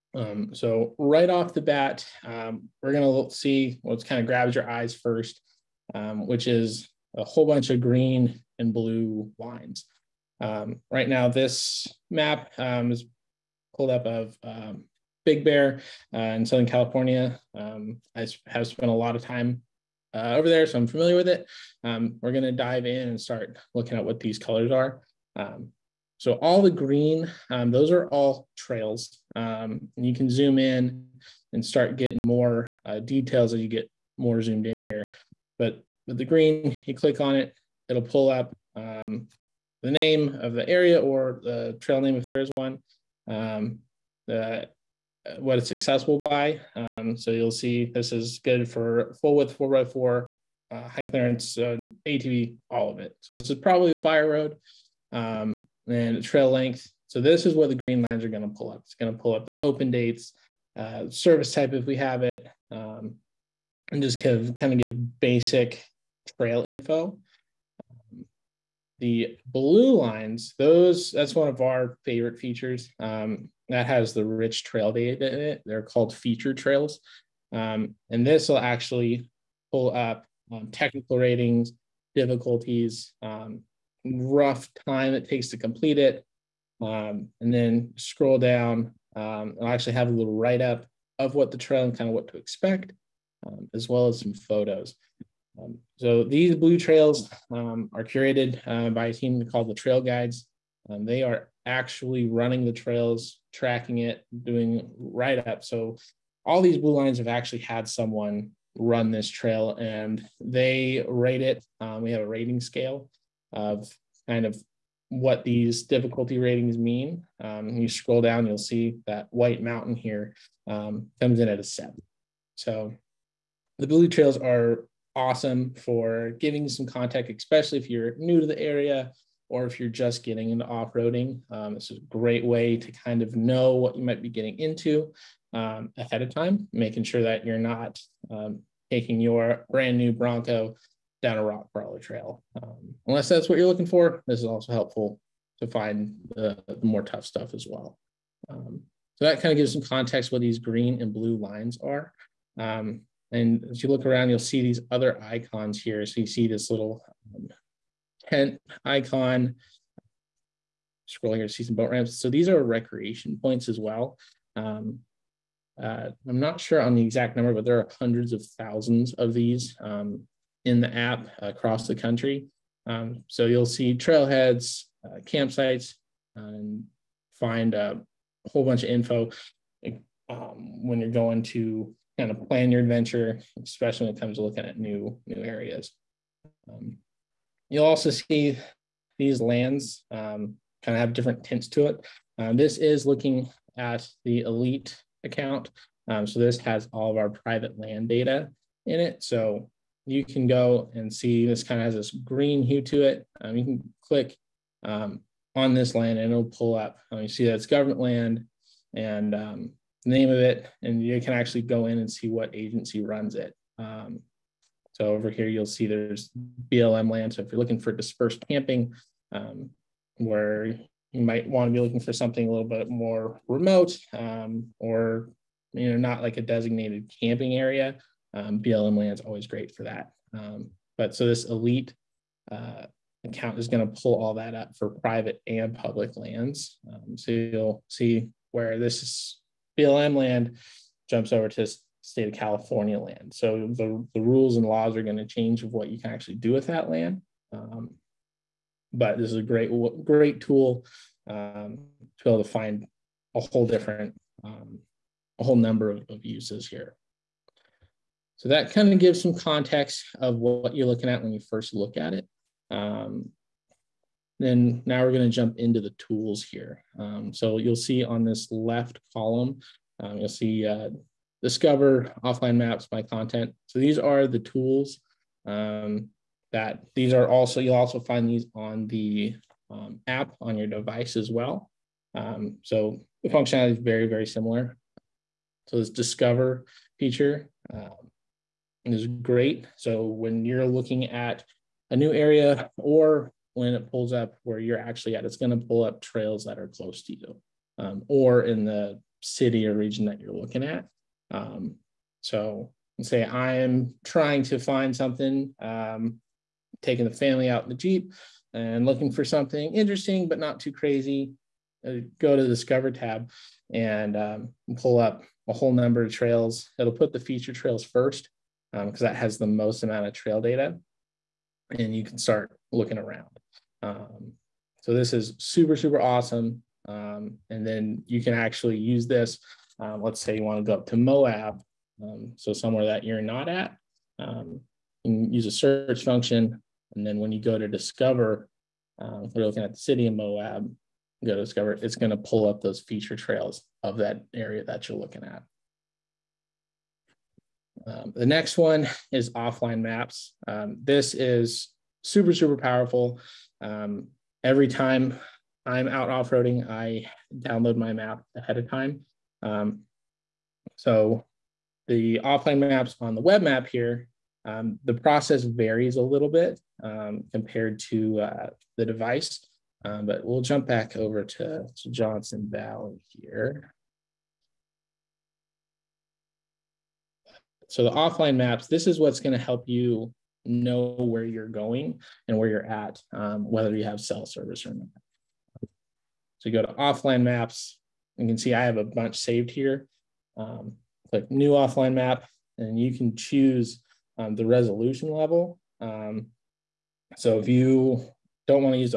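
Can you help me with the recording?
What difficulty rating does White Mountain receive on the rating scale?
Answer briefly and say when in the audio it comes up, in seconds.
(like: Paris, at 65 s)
7, at 121 s.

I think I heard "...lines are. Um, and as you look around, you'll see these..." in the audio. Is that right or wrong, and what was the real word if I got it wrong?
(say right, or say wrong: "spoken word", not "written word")
right.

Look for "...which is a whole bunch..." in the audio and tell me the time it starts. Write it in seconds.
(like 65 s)
6 s.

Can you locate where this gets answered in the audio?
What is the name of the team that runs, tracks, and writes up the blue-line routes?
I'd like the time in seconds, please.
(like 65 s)
99 s.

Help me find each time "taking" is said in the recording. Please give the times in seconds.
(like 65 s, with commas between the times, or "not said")
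138 s, 306 s.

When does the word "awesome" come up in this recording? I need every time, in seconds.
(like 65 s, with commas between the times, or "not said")
125 s, 326 s.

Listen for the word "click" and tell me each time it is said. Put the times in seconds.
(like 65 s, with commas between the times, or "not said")
36 s, 204 s, 391 s.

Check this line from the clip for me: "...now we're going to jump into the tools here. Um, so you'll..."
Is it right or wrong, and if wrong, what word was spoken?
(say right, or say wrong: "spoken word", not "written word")
right.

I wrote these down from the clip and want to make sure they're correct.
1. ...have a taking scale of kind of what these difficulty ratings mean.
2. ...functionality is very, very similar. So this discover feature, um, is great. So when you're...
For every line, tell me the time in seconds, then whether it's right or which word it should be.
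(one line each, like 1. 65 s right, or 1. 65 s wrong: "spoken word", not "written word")
1. 112 s wrong: "rating", not "taking"
2. 283 s right.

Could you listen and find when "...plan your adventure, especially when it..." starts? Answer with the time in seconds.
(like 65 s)
182 s.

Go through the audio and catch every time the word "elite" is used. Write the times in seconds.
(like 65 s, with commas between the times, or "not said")
194 s, 231 s.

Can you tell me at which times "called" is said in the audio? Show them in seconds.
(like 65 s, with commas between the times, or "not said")
75 s, 99 s.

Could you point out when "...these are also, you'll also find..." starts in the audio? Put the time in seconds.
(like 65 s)
276 s.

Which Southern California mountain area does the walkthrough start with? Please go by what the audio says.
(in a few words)
Big Bear.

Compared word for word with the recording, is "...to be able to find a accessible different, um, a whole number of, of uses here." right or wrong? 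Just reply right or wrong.
wrong.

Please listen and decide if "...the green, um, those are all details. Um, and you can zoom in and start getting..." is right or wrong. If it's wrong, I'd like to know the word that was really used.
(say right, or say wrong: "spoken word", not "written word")
wrong: "trails", not "details".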